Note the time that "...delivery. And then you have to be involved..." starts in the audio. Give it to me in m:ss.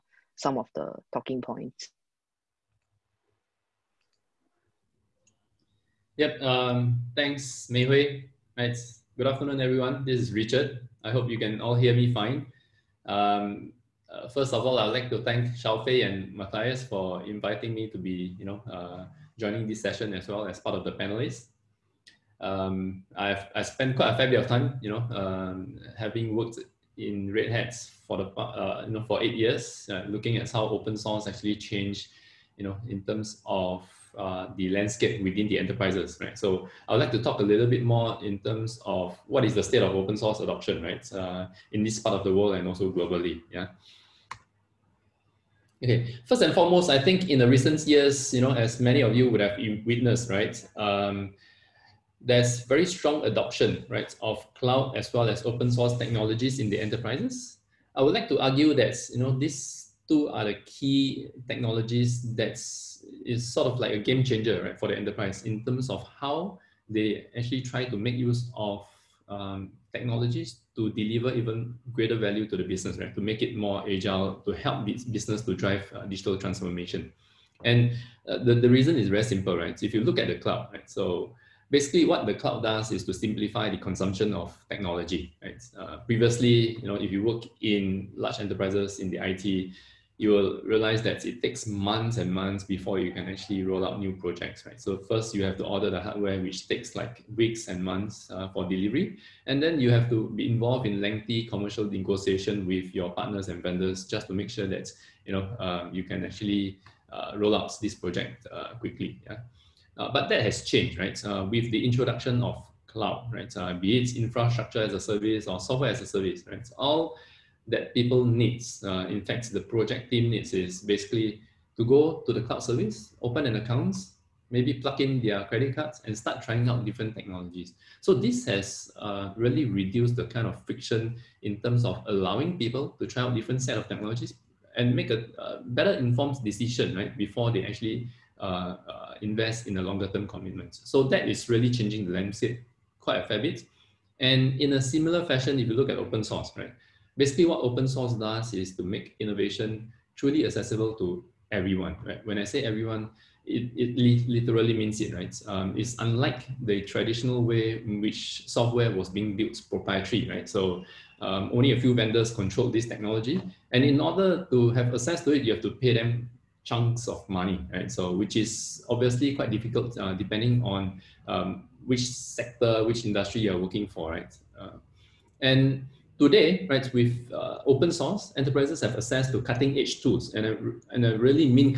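1:38.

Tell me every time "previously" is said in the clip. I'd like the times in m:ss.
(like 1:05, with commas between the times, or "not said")
1:25.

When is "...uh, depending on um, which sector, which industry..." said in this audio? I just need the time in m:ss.
2:49.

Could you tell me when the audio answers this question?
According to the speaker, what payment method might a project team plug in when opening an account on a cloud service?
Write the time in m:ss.
2:05.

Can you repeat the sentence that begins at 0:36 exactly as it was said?
So I would like to talk a little bit more in terms of what is the state of open source adoption, right?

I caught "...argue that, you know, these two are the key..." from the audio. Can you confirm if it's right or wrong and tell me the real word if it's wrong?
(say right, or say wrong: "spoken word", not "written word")
right.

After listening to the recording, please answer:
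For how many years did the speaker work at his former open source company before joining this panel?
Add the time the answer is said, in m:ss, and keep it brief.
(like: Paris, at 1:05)
8, at 0:29.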